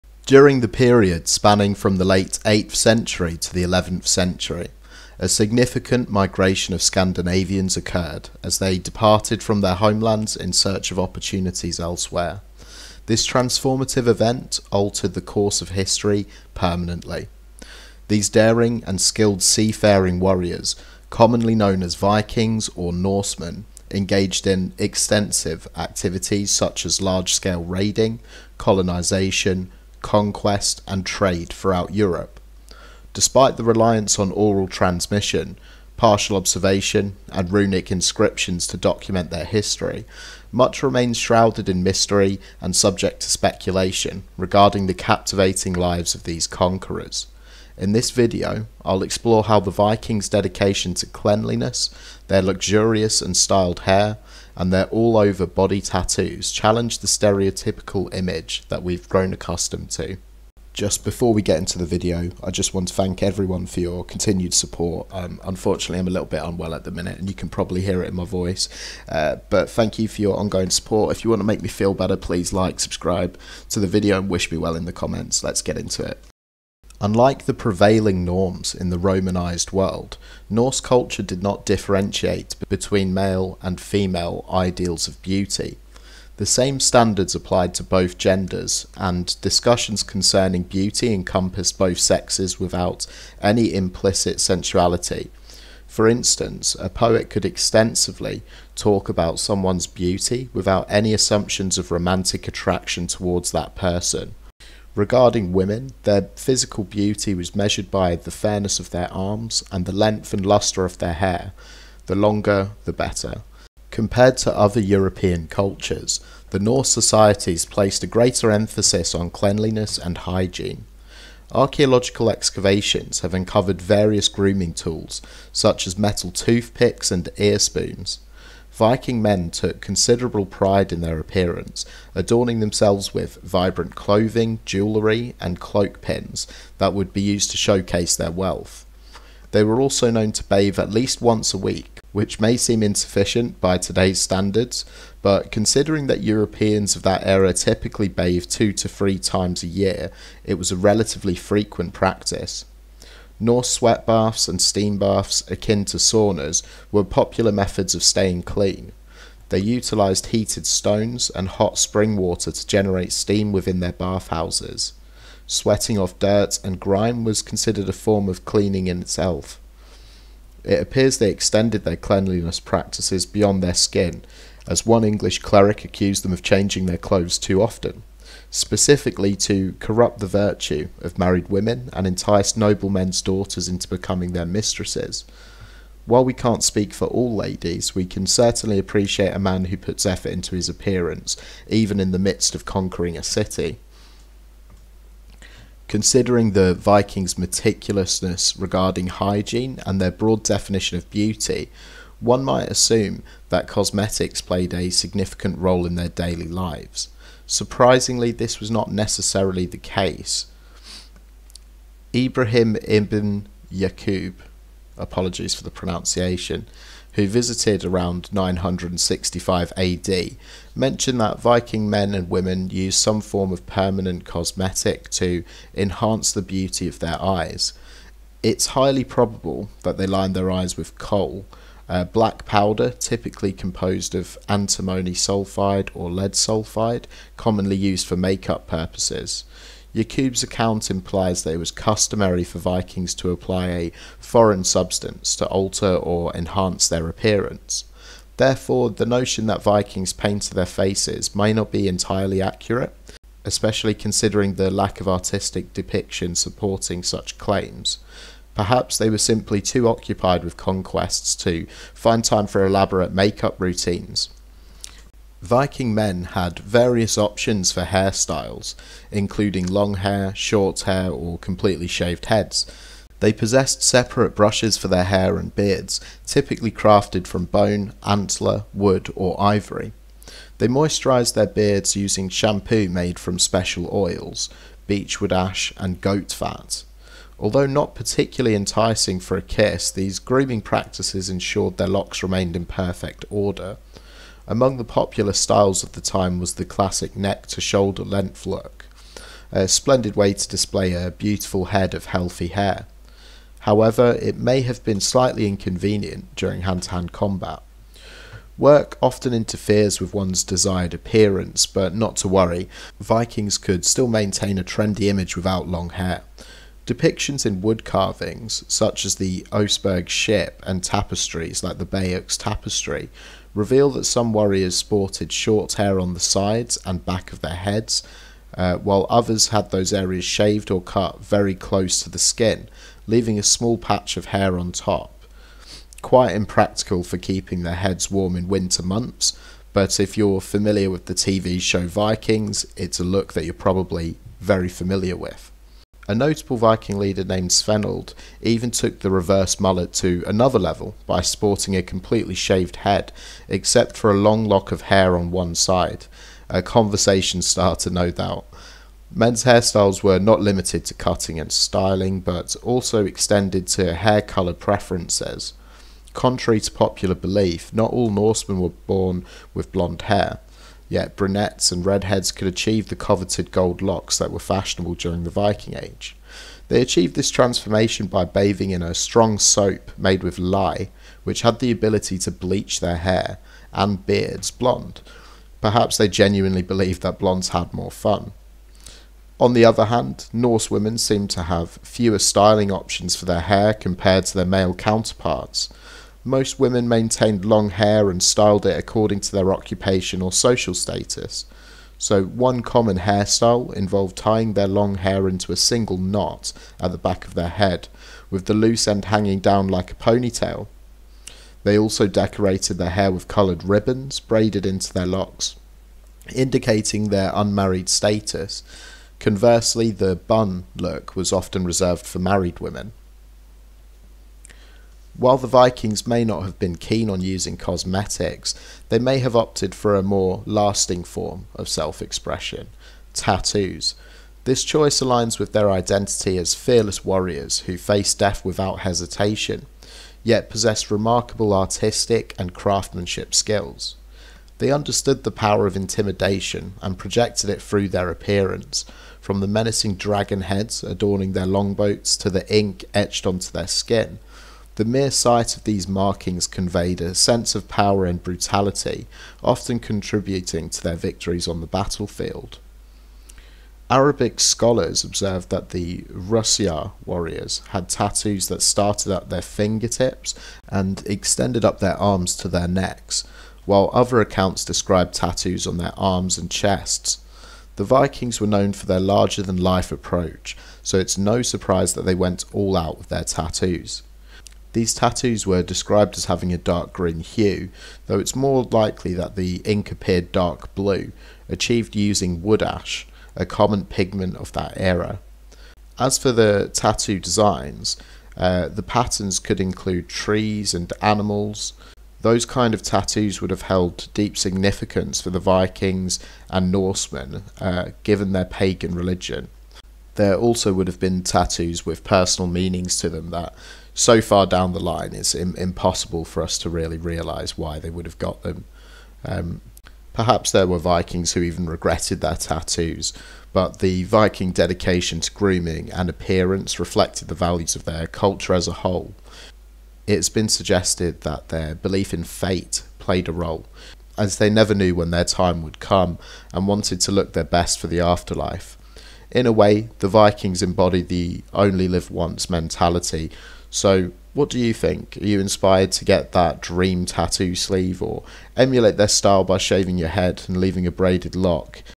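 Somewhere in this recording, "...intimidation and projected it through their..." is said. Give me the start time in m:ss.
7:25.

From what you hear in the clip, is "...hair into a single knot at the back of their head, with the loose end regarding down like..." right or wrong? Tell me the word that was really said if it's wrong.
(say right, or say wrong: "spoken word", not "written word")
wrong: "hanging", not "regarding".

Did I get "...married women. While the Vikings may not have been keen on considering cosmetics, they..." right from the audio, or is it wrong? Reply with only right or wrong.
wrong.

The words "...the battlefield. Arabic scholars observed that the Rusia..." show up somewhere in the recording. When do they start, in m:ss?
7:41.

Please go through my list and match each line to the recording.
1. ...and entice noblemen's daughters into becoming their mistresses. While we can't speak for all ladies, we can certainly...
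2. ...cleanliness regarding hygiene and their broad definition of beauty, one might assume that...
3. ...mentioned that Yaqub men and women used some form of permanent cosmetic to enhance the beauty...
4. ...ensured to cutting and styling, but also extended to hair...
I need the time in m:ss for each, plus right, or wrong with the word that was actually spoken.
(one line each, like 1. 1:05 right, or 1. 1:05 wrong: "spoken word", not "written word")
1. 3:01 right
2. 3:17 wrong: "meticulousness", not "cleanliness"
3. 3:40 wrong: "Viking", not "Yaqub"
4. 6:00 wrong: "limited", not "ensured".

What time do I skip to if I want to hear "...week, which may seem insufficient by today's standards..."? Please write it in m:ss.
2:21.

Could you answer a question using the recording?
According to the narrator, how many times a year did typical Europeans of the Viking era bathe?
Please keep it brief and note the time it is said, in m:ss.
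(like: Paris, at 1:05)
2 to 3 times, at 2:28.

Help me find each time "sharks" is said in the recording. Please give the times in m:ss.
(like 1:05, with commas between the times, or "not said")
not said.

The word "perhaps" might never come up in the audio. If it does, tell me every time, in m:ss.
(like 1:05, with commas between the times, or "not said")
4:18, 6:25, 8:40.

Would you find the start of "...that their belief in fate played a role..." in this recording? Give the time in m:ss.
8:51.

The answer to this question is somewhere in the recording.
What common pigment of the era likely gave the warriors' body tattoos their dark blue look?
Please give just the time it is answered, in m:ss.
8:12.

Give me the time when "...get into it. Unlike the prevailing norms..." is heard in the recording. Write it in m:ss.
1:15.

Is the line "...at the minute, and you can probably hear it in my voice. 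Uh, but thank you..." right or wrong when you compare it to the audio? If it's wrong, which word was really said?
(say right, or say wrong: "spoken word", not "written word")
right.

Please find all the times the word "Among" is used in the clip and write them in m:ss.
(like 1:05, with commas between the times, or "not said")
4:54.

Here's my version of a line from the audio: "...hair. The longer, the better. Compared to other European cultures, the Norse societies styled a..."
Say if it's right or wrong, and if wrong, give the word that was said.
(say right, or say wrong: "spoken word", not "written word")
wrong: "placed", not "styled".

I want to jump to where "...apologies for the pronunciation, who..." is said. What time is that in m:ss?
3:34.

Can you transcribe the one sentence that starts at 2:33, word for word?
Norse sweat baths and steam baths, akin to saunas, were popular methods of staying clean.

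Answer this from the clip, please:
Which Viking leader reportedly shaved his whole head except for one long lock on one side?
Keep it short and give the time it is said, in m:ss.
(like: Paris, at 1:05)
Svenold, at 5:47.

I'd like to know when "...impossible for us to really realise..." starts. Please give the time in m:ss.
8:35.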